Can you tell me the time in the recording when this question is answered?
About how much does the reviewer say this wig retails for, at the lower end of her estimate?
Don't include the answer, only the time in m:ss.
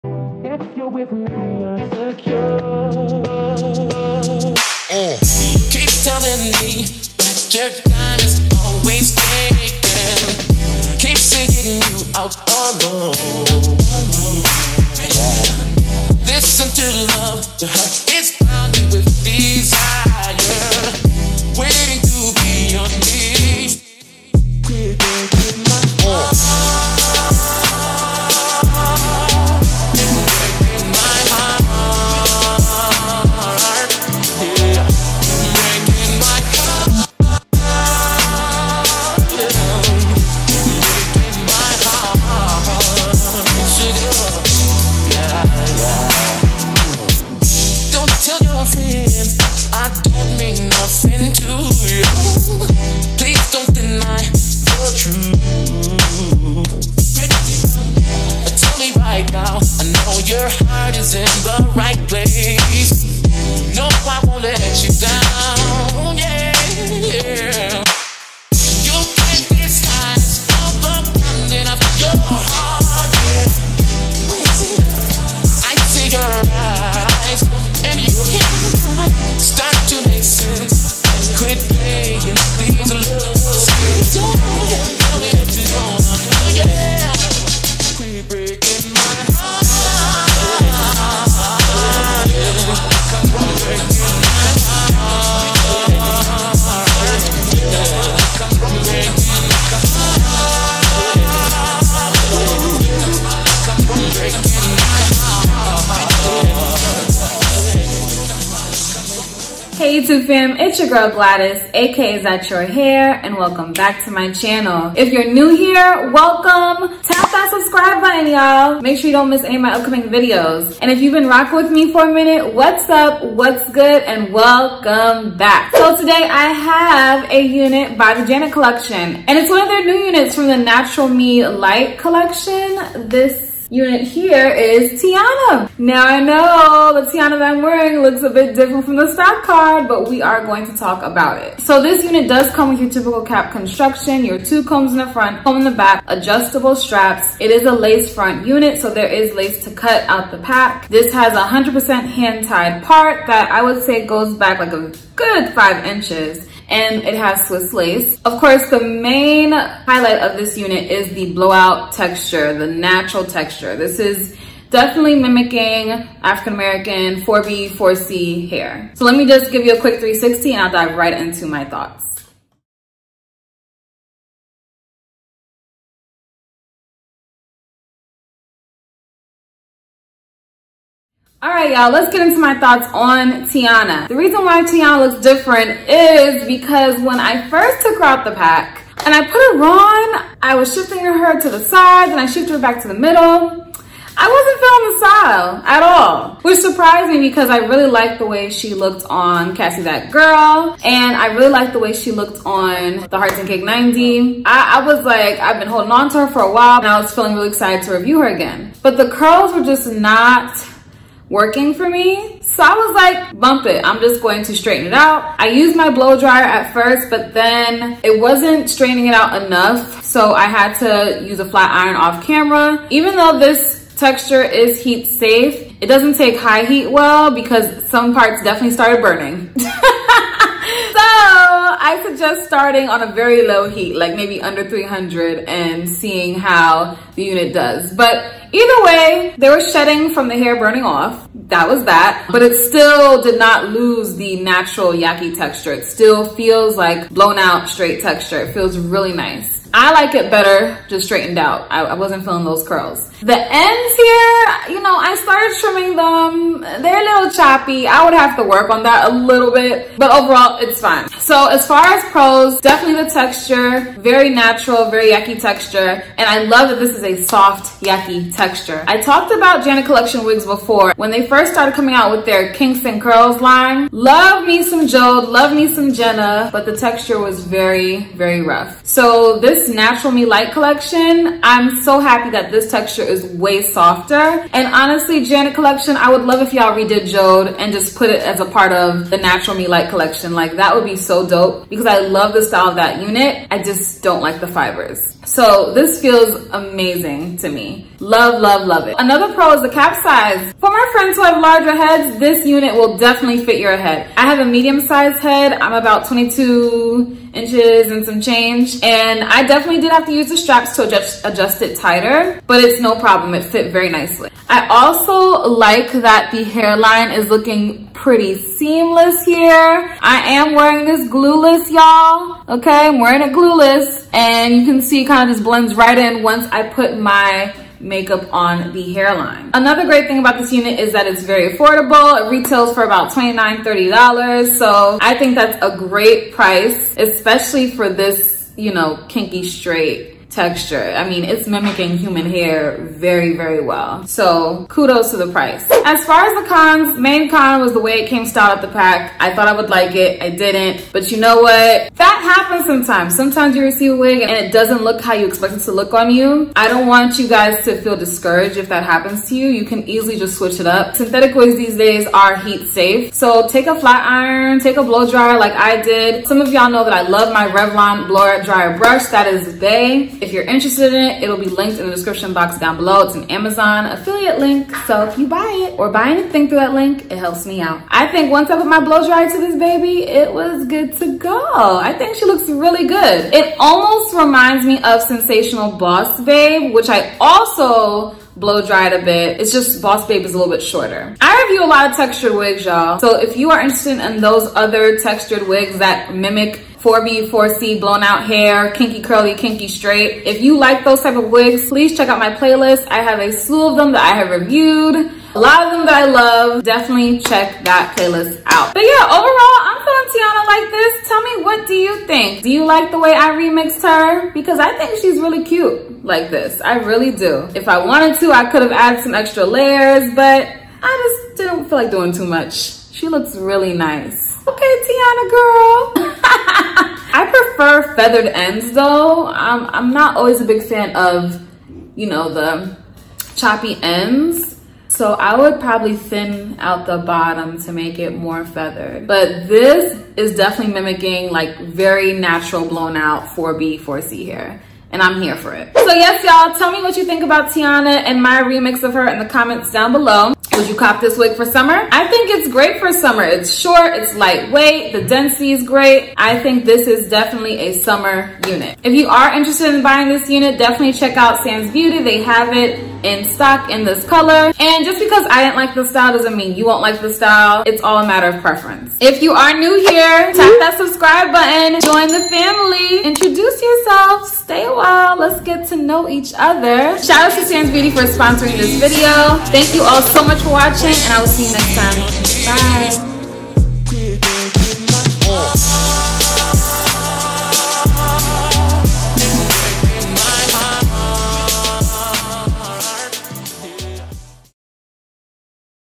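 5:33.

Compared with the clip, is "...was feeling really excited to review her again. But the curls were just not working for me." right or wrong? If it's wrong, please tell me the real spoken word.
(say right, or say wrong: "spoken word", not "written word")
right.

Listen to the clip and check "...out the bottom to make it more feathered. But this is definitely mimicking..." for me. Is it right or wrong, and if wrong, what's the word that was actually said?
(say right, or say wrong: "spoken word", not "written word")
right.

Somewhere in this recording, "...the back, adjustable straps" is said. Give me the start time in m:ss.
2:25.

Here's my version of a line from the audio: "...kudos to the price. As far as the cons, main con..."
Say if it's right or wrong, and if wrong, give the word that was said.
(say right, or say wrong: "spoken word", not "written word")
right.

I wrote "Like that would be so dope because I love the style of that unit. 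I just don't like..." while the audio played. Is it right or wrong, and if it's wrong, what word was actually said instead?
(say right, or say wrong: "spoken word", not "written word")
right.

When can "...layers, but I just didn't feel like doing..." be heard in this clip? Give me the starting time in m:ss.
6:59.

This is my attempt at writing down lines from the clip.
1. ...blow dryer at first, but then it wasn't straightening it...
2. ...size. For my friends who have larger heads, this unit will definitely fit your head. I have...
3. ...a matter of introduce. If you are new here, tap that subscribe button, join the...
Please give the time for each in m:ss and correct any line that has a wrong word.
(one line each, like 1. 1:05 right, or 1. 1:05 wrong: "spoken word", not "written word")
1. 3:35 right
2. 5:00 right
3. 7:47 wrong: "preference", not "introduce".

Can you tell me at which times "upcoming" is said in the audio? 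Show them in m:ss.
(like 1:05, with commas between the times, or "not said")
1:59.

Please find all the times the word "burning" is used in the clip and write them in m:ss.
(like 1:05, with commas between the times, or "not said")
3:49, 4:00.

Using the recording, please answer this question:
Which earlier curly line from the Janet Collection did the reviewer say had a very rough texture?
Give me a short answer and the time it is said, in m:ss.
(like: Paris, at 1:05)
Kingston Curls, at 4:32.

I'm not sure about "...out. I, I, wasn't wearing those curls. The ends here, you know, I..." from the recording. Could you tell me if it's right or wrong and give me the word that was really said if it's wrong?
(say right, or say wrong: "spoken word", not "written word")
wrong: "feeling", not "wearing".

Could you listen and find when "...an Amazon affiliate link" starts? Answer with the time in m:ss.
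6:13.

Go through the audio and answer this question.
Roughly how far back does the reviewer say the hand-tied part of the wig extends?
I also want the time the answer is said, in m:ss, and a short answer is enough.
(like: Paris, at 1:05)
5 inches, at 2:35.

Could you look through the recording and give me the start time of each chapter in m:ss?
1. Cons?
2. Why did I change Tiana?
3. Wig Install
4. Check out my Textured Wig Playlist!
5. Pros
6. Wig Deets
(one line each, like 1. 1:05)
1. 5:45
2. 3:01
3. 0:29
4. 6:35
5. 4:20
6. 2:04.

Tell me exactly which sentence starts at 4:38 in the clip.
So this this Natural Me Light collection, I'm so happy that this texture is way softer.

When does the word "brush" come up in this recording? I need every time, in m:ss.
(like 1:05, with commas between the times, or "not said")
6:08.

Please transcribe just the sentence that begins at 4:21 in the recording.
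So as far as pros, definitely the texture, very natural, very yaki texture.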